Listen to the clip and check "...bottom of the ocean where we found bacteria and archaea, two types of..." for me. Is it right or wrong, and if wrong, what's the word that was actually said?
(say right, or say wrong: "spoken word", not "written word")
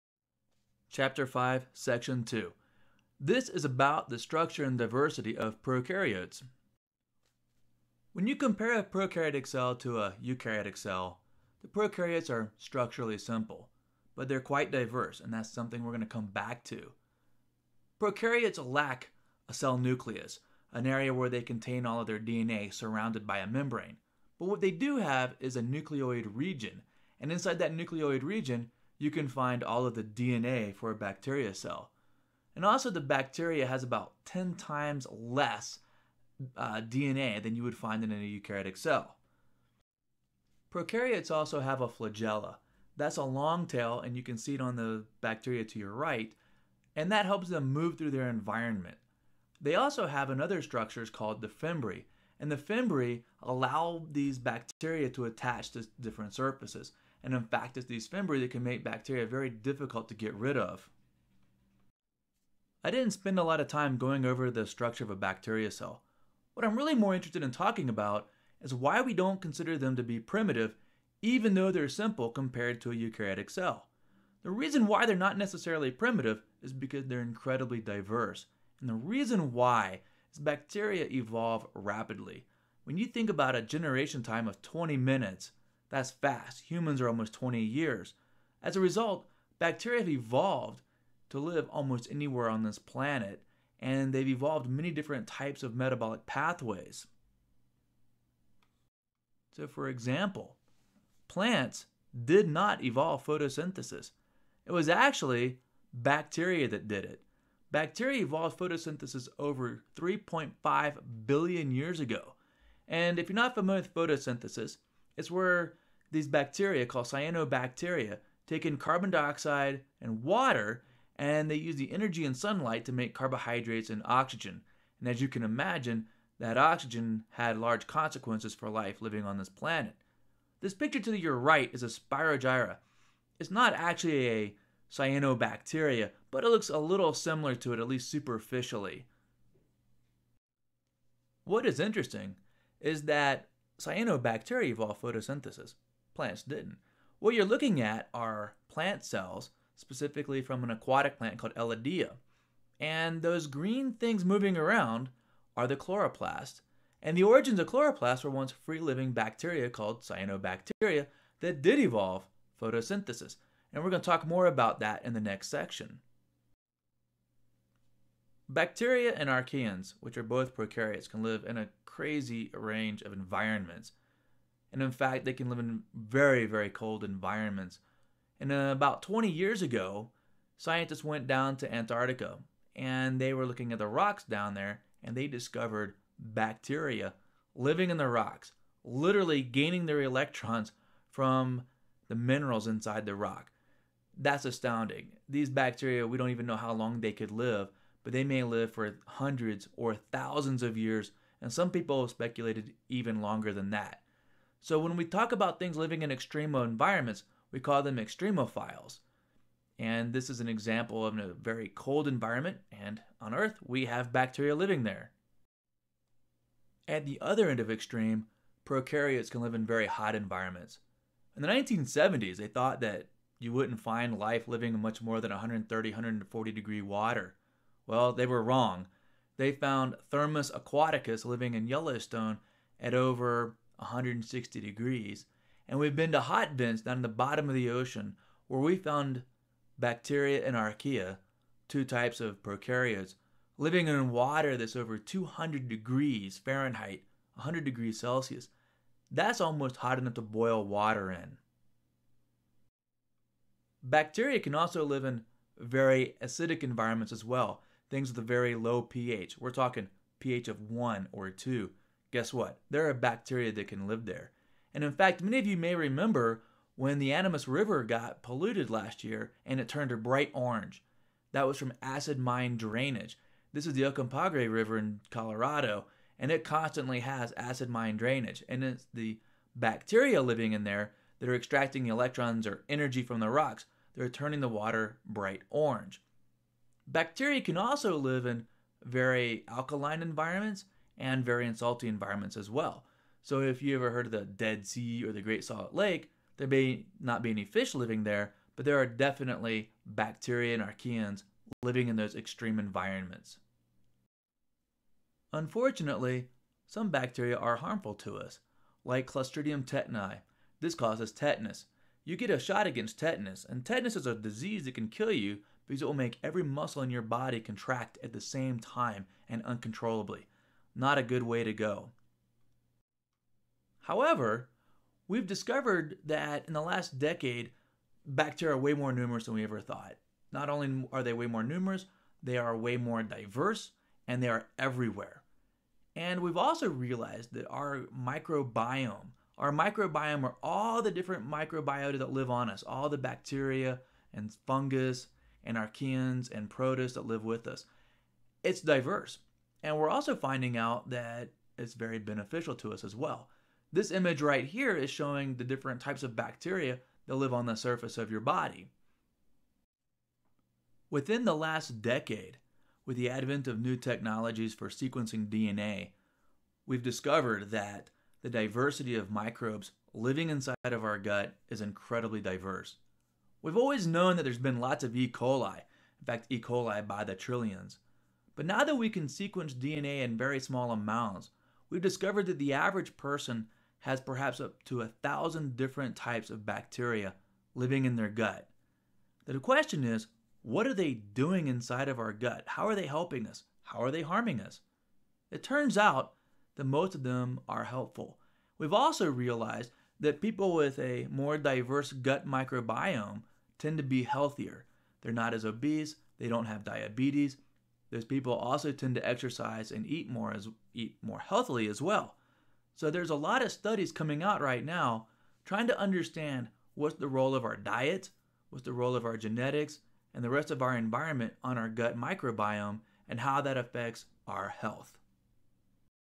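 right.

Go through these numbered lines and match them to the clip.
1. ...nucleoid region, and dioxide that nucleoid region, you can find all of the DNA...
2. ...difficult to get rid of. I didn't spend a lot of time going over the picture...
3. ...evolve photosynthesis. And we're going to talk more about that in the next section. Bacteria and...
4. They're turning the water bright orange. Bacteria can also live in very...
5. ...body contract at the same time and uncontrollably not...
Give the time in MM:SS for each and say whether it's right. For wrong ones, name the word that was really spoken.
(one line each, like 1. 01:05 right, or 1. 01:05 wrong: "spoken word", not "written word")
1. 00:25 wrong: "inside", not "dioxide"
2. 00:59 wrong: "structure", not "picture"
3. 02:41 right
4. 04:43 right
5. 05:17 right.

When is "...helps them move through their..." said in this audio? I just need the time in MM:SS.
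00:47.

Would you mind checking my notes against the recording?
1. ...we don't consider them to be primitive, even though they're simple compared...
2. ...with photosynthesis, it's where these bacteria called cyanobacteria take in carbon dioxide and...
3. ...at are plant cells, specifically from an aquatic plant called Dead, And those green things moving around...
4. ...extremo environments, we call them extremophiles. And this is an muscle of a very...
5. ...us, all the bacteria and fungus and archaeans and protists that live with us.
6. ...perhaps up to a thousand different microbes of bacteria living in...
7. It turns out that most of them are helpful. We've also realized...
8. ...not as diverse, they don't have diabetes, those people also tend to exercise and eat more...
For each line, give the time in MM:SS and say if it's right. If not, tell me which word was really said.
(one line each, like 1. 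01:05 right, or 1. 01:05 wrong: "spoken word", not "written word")
1. 01:09 right
2. 01:53 right
3. 02:27 wrong: "Elodea", not "Dead"
4. 03:26 wrong: "example", not "muscle"
5. 05:42 right
6. 06:23 wrong: "types", not "microbes"
7. 06:35 right
8. 06:45 wrong: "obese", not "diverse".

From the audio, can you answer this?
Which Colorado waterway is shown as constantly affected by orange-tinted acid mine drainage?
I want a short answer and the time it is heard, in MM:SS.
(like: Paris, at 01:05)
Uncompahgre River, at 04:33.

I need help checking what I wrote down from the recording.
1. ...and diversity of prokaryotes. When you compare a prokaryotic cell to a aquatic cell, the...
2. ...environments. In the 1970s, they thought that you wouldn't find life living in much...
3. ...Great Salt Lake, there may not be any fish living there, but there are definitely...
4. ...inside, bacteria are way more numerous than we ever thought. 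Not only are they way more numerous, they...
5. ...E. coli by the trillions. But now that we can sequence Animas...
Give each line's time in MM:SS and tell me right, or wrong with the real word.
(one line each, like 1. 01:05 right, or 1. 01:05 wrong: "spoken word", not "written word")
1. 00:04 wrong: "eukaryotic", not "aquatic"
2. 03:40 right
3. 04:55 right
4. 05:26 wrong: "decade", not "inside"
5. 06:16 wrong: "DNA", not "Animas".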